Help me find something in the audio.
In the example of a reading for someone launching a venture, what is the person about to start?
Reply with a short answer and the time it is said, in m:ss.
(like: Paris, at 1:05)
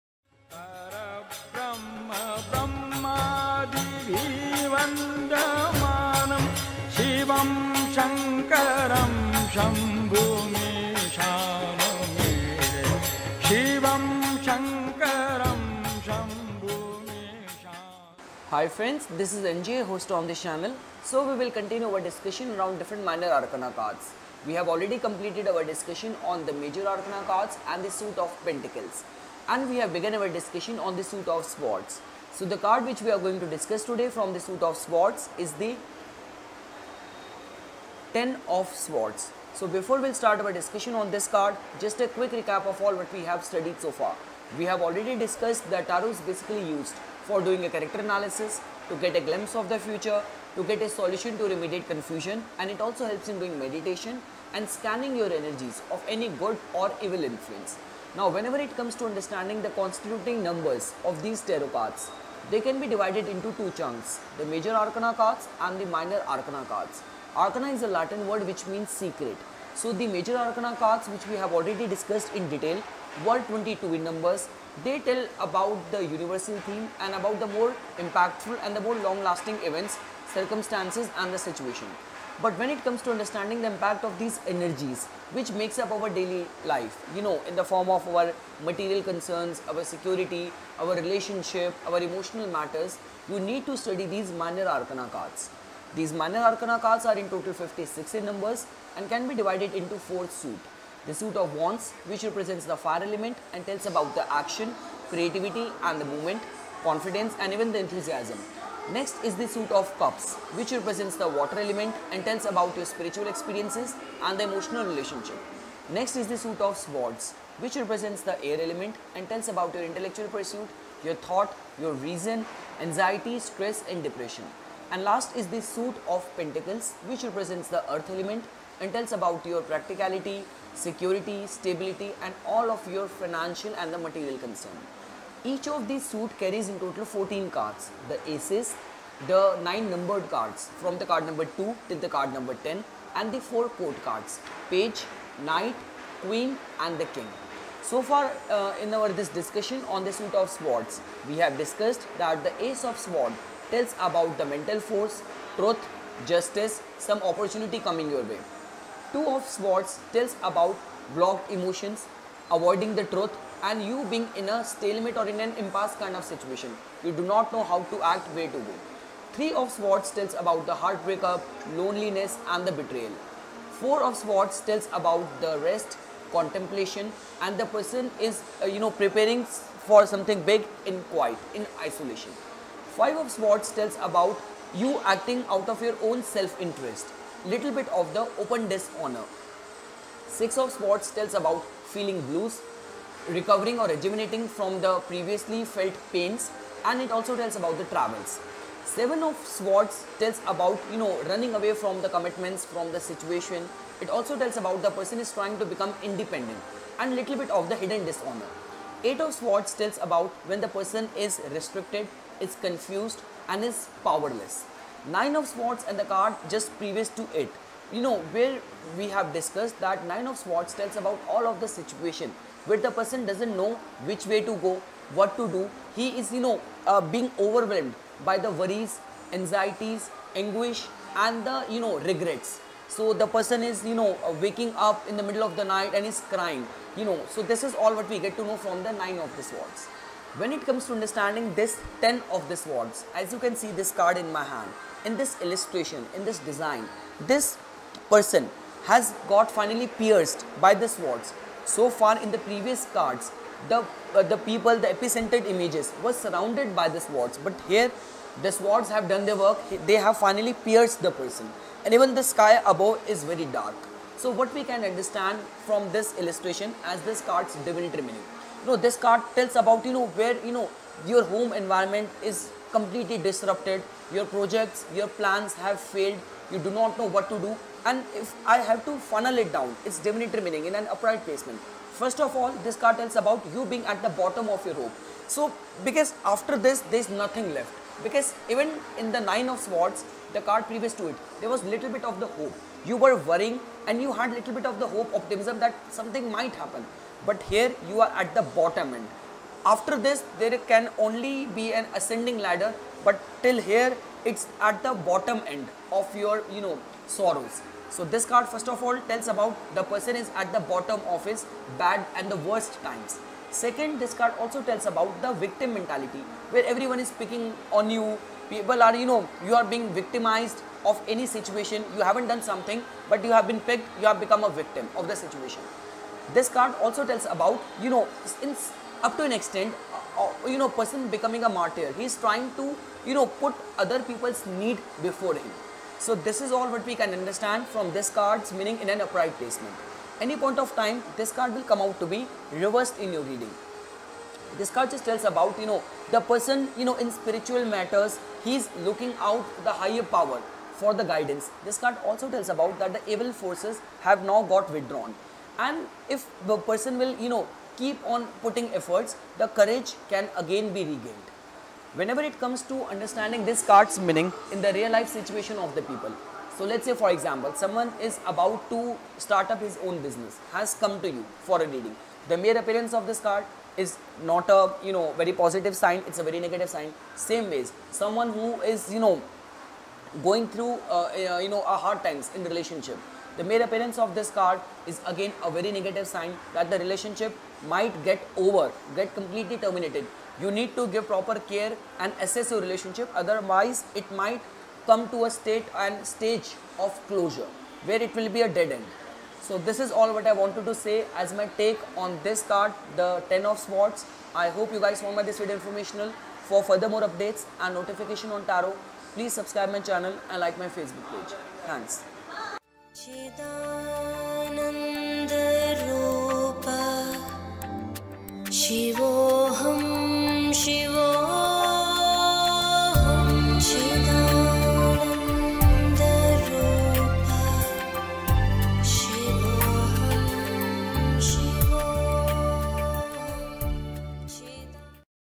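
His own business, at 6:09.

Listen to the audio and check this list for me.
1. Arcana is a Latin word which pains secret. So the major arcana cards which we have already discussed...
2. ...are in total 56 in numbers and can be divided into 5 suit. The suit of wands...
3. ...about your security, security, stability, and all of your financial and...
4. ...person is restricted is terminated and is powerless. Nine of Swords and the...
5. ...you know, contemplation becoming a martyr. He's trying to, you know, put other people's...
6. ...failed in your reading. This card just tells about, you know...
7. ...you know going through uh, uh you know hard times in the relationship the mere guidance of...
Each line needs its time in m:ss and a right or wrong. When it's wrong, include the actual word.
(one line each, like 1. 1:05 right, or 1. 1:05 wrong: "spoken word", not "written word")
1. 1:07 wrong: "means", not "pains"
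2. 1:37 wrong: "4", not "5"
3. 2:09 wrong: "practicality", not "security"
4. 3:30 wrong: "confused", not "terminated"
5. 5:30 wrong: "person", not "contemplation"
6. 5:42 wrong: "reversed", not "failed"
7. 6:18 wrong: "appearance", not "guidance".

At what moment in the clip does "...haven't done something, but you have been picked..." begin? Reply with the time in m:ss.
5:22.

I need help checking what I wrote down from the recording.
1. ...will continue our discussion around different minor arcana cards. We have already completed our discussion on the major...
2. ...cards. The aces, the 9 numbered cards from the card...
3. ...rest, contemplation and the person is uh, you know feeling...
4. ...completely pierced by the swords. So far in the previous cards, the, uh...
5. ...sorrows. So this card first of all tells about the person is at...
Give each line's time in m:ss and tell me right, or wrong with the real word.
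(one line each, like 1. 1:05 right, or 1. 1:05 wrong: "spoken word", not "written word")
1. 0:21 right
2. 2:17 right
3. 2:55 wrong: "preparing", not "feeling"
4. 4:09 wrong: "finally", not "completely"
5. 5:07 right.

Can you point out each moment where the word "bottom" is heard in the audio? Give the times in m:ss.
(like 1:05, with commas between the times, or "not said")
4:44, 4:58, 5:04, 5:10.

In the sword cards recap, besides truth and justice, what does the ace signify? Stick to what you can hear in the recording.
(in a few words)
mental force.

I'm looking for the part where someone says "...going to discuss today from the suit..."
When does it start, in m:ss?
0:33.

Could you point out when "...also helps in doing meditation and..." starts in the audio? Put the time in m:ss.
0:52.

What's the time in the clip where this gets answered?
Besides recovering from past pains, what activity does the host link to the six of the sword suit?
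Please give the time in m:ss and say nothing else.
3:17.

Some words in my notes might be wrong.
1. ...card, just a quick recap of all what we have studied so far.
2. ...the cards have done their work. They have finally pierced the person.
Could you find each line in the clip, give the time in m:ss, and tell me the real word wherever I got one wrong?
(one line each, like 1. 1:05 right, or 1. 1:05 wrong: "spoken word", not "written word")
1. 0:41 right
2. 4:18 wrong: "swords", not "cards".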